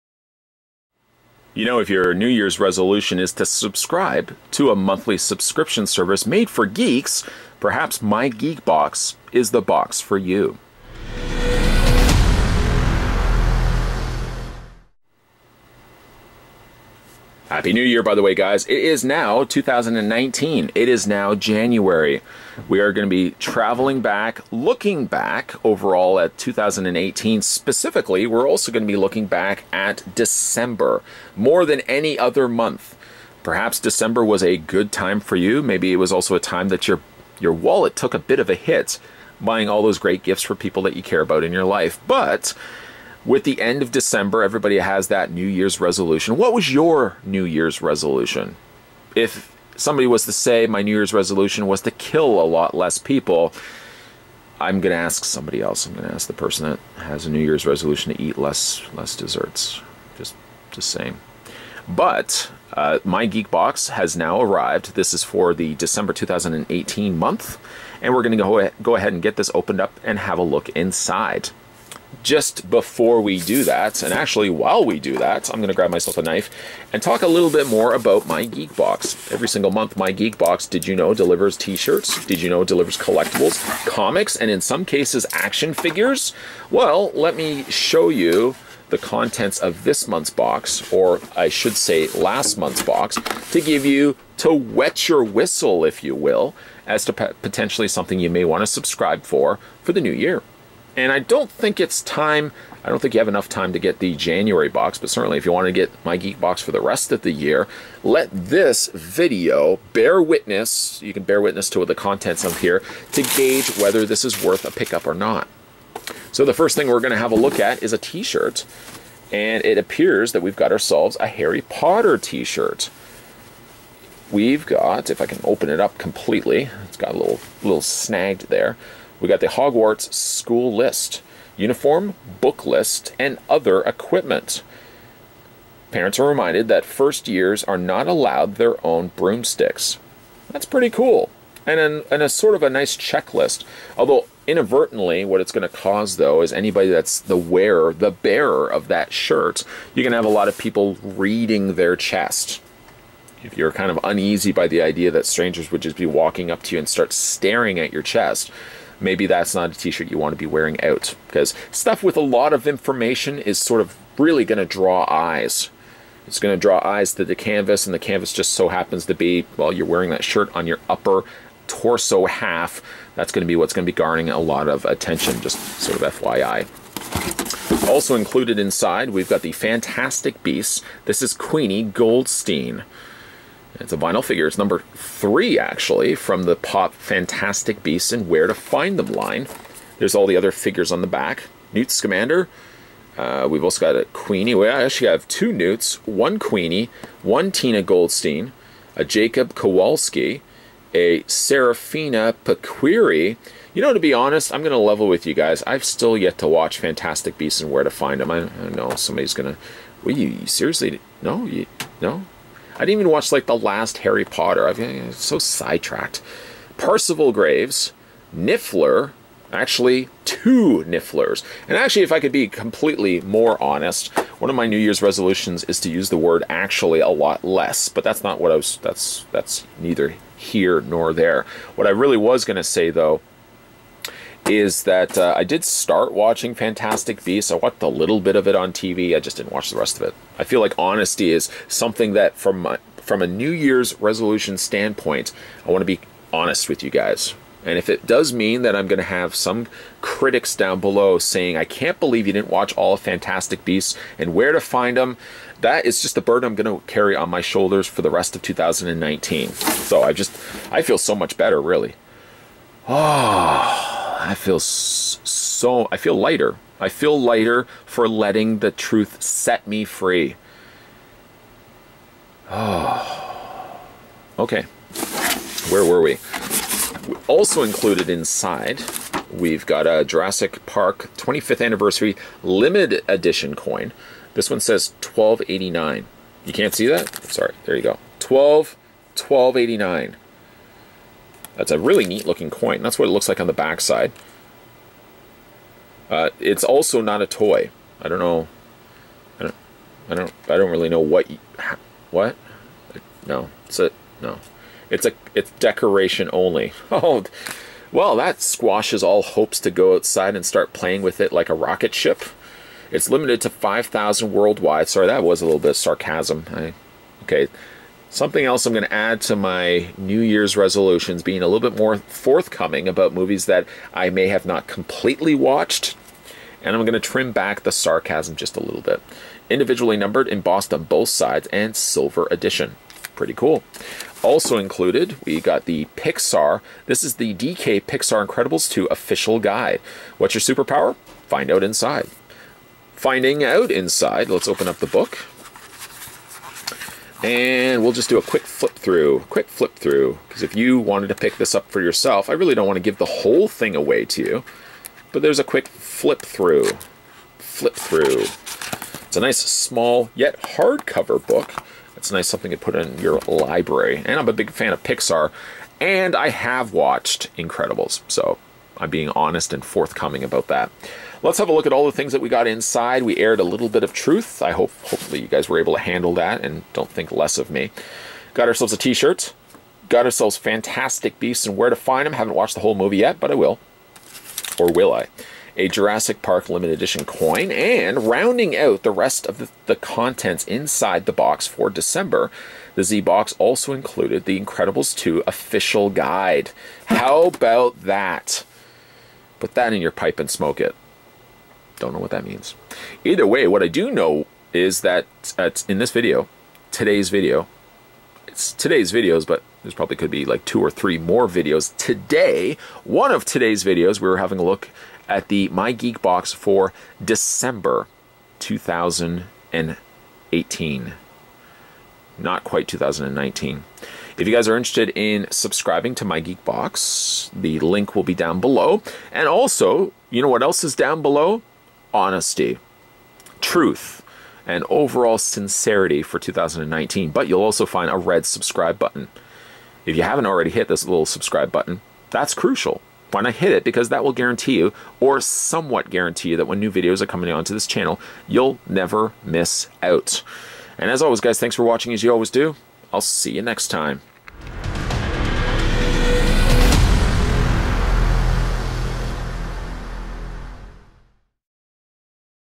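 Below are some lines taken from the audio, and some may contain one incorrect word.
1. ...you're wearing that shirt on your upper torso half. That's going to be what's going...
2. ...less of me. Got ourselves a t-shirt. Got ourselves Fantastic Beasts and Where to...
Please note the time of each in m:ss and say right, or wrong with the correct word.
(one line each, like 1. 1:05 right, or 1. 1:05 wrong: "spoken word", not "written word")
1. 2:49 right
2. 6:17 right.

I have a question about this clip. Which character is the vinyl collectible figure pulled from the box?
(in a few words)
Queenie Goldstein.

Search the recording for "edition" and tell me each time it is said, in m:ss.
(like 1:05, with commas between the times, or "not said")
4:43, 5:32, 6:26.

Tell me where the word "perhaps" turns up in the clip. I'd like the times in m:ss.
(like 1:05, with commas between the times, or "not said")
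0:07, 0:33.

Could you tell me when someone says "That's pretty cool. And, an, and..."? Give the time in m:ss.
2:20.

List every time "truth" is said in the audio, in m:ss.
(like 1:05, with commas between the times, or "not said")
4:28, 6:13, 7:13.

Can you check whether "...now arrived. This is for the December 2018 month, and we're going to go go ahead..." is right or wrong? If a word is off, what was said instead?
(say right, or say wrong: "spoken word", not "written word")
right.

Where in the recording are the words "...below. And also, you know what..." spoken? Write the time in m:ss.
7:08.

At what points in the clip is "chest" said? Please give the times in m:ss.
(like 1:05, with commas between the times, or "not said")
2:31, 2:38.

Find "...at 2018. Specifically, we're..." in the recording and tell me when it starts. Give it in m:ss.
0:26.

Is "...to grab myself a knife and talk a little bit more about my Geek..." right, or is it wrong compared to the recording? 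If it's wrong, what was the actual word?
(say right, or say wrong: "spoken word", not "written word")
right.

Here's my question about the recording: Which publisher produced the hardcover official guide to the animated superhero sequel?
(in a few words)
DK.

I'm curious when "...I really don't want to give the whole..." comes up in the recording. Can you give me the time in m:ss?
5:52.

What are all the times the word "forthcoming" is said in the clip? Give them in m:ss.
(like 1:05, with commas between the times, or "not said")
5:21, 6:09.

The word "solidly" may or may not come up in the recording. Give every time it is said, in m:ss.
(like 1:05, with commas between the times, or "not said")
not said.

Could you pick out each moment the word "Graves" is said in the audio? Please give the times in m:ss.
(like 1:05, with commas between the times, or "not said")
3:37.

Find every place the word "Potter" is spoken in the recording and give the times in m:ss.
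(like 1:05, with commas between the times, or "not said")
2:01, 3:34.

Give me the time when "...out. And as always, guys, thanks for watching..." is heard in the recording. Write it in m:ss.
7:29.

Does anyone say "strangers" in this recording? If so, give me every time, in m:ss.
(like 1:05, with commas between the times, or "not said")
2:35.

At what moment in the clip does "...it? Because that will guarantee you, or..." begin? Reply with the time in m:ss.
7:23.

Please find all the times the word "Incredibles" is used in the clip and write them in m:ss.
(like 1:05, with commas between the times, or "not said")
5:38, 6:07, 6:34.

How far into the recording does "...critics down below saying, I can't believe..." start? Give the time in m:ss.
4:10.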